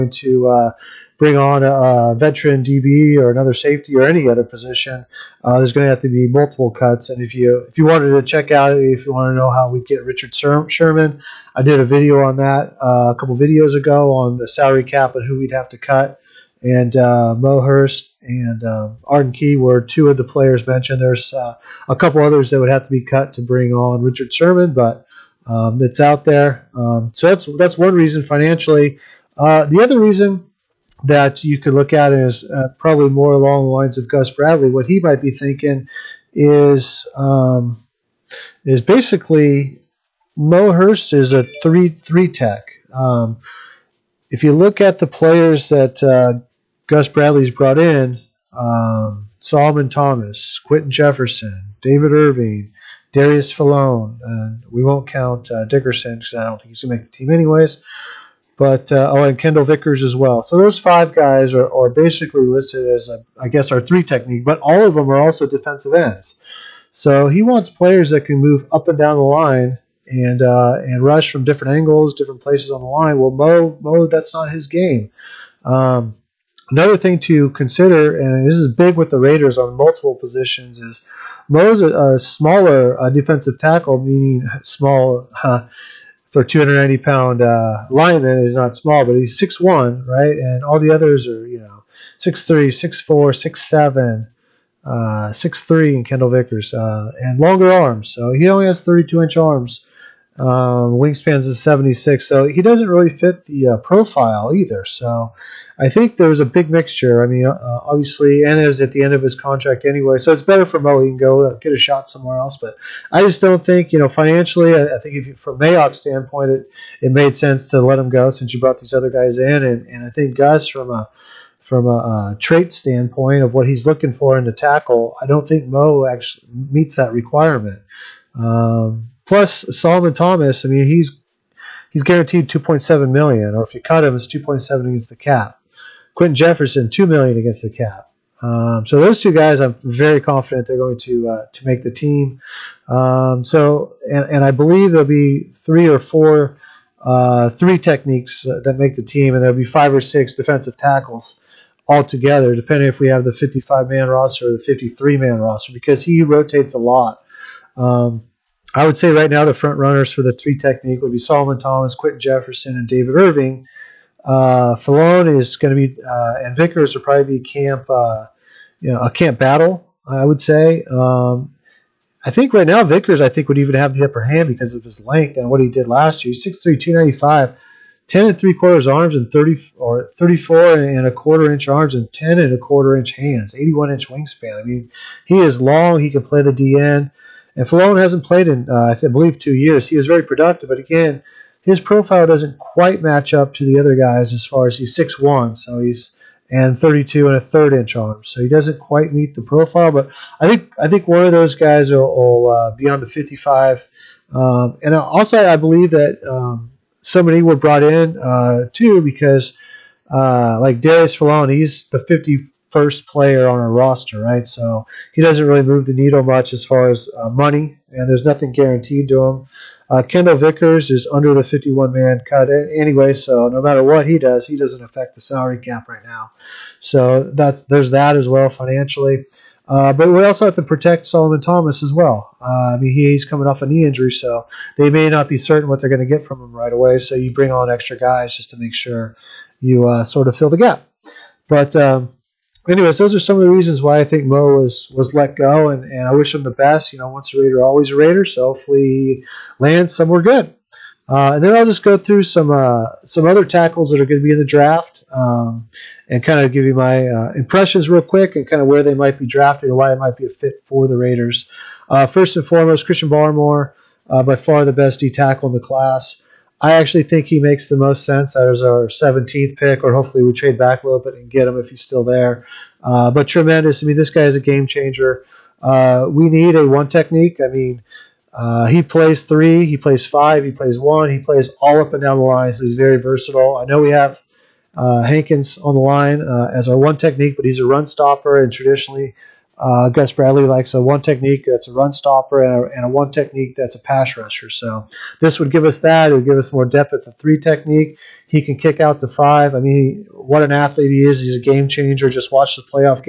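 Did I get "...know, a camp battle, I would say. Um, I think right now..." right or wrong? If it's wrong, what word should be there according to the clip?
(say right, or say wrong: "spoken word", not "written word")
right.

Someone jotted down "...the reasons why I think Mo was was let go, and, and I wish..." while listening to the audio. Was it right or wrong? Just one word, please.
right.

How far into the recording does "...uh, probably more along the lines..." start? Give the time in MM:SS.
00:32.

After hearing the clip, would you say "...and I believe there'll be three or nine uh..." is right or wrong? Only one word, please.
wrong.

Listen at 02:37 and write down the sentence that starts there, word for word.
Um, I would say right now the front runners for the three technique would be Solomon Thomas, Quinton Jefferson, and David Irving.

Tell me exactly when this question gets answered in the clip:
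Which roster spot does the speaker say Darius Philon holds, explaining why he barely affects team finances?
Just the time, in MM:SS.
03:31.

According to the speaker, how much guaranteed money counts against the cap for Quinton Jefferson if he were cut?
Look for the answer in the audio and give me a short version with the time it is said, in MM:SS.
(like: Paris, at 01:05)
2 million, at 02:16.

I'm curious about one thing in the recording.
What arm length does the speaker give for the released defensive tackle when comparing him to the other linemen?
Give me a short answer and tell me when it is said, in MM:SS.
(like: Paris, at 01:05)
32 inches, at 01:38.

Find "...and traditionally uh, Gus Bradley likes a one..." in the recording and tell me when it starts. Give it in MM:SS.
04:48.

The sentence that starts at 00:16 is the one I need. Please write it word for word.
And uh, Mo Hurst and um, Arden Key were two of the players mentioned.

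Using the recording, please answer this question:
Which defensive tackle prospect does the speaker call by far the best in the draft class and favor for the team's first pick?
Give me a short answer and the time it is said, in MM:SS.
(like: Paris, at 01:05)
Christian Barmore, at 04:22.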